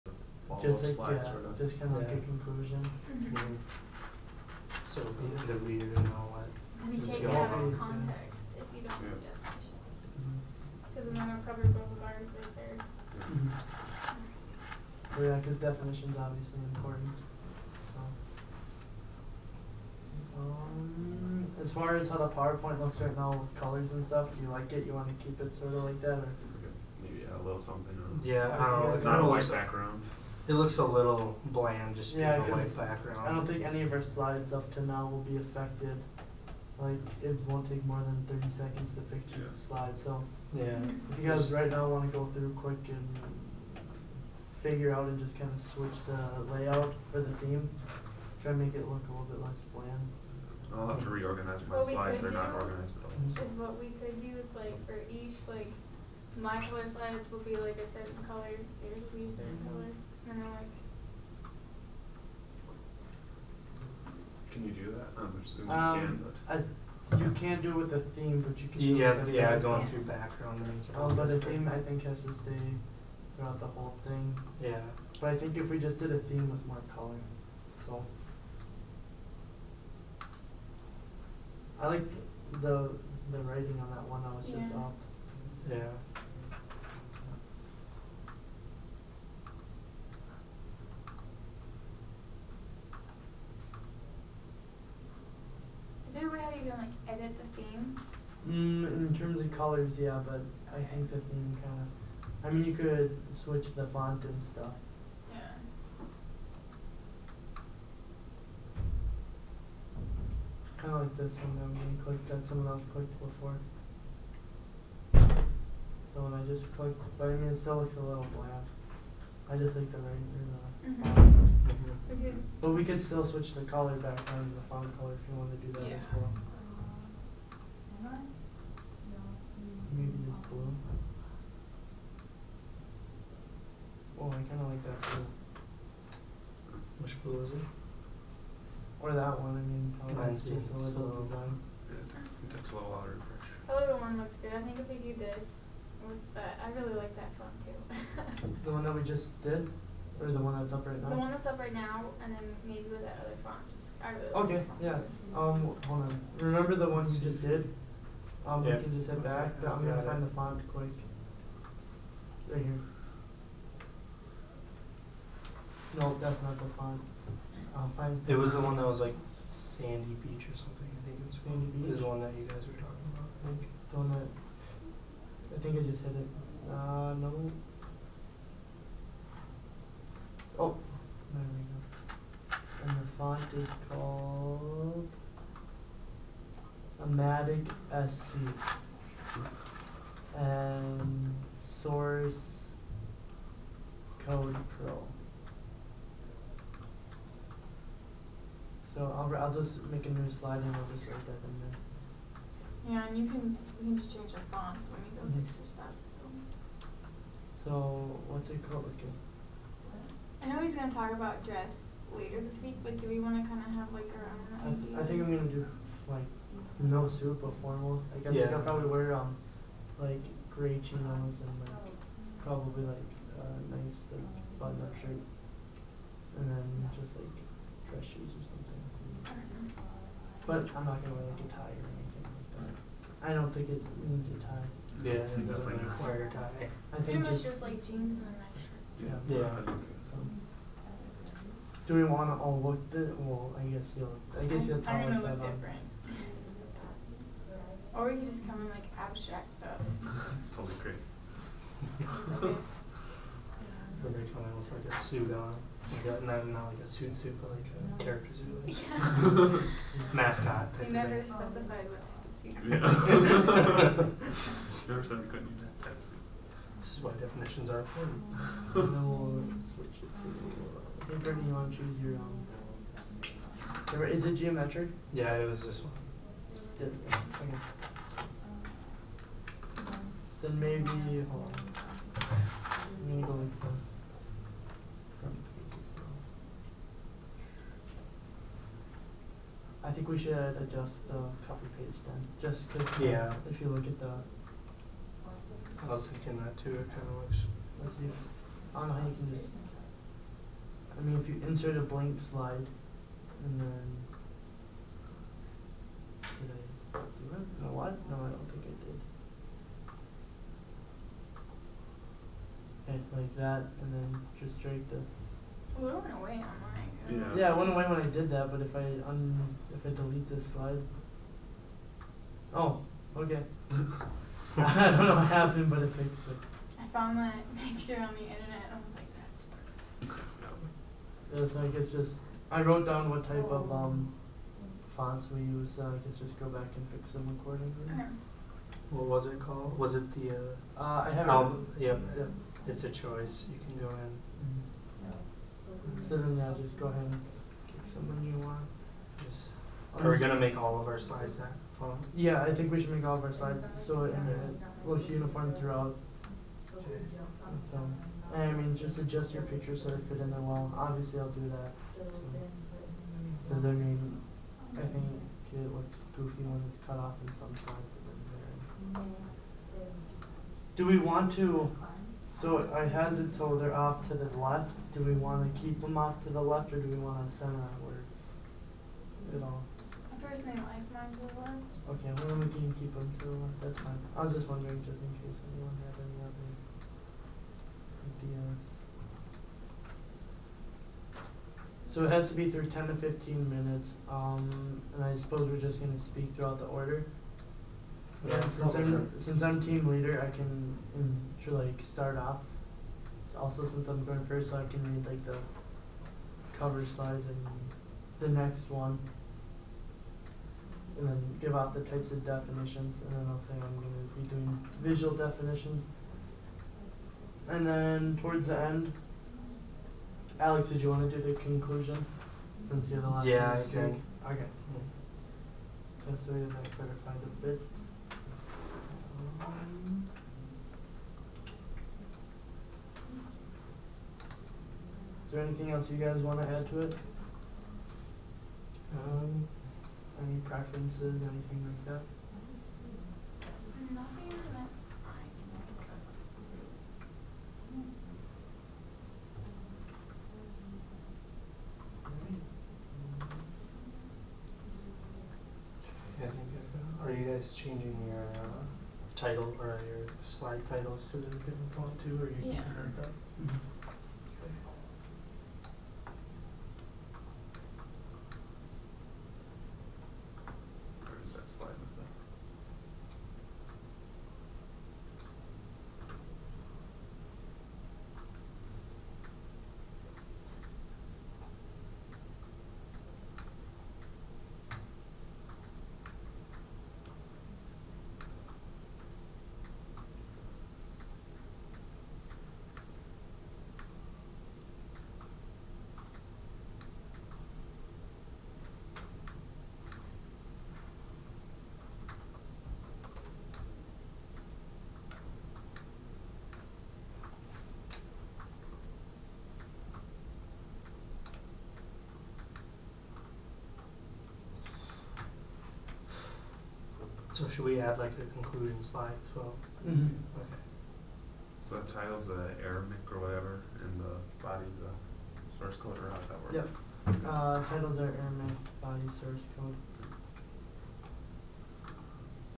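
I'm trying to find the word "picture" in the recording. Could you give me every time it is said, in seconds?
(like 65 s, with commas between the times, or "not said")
39 s, 327 s, 359 s.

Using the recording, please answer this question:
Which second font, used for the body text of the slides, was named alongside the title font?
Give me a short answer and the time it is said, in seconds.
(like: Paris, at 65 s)
Source Code Pro, at 191 s.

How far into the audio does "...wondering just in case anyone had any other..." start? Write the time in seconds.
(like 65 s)
384 s.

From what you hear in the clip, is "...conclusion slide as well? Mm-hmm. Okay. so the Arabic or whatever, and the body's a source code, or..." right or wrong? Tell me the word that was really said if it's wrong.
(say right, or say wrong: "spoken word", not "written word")
right.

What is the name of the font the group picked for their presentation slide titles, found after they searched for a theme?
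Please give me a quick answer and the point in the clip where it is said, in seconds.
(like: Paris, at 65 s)
Amatic SC, at 187 s.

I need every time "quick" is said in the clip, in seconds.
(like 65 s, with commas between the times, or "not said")
42 s, 160 s.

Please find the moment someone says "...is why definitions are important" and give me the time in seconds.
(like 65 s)
266 s.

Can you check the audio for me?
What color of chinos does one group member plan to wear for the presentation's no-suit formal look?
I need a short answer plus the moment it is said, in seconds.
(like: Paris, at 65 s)
Gray, at 220 s.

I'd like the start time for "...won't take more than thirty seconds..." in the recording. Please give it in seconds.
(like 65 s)
37 s.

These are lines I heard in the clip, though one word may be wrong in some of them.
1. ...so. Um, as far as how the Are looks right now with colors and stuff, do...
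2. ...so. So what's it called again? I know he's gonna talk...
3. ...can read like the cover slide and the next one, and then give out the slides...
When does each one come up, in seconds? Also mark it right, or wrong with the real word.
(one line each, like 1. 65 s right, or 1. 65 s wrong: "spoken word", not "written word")
1. 17 s wrong: "PowerPoint", not "Are"
2. 206 s right
3. 404 s wrong: "types", not "slides".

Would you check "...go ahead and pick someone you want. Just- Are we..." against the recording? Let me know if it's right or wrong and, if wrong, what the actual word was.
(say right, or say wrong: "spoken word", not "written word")
right.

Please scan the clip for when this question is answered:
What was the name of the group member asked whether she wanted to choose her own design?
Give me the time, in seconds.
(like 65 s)
271 s.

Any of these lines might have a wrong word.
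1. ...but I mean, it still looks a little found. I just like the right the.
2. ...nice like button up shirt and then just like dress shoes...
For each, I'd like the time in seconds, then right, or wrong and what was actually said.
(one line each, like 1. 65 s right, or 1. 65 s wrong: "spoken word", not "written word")
1. 117 s wrong: "bland", not "found"
2. 223 s right.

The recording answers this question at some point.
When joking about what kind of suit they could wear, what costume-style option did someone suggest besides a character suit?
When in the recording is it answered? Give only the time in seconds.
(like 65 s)
260 s.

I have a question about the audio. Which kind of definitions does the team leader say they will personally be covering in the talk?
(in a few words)
Visual definitions.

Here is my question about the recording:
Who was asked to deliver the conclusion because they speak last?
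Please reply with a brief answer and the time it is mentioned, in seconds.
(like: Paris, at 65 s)
Alex, at 420 s.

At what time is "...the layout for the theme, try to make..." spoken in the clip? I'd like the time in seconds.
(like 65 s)
46 s.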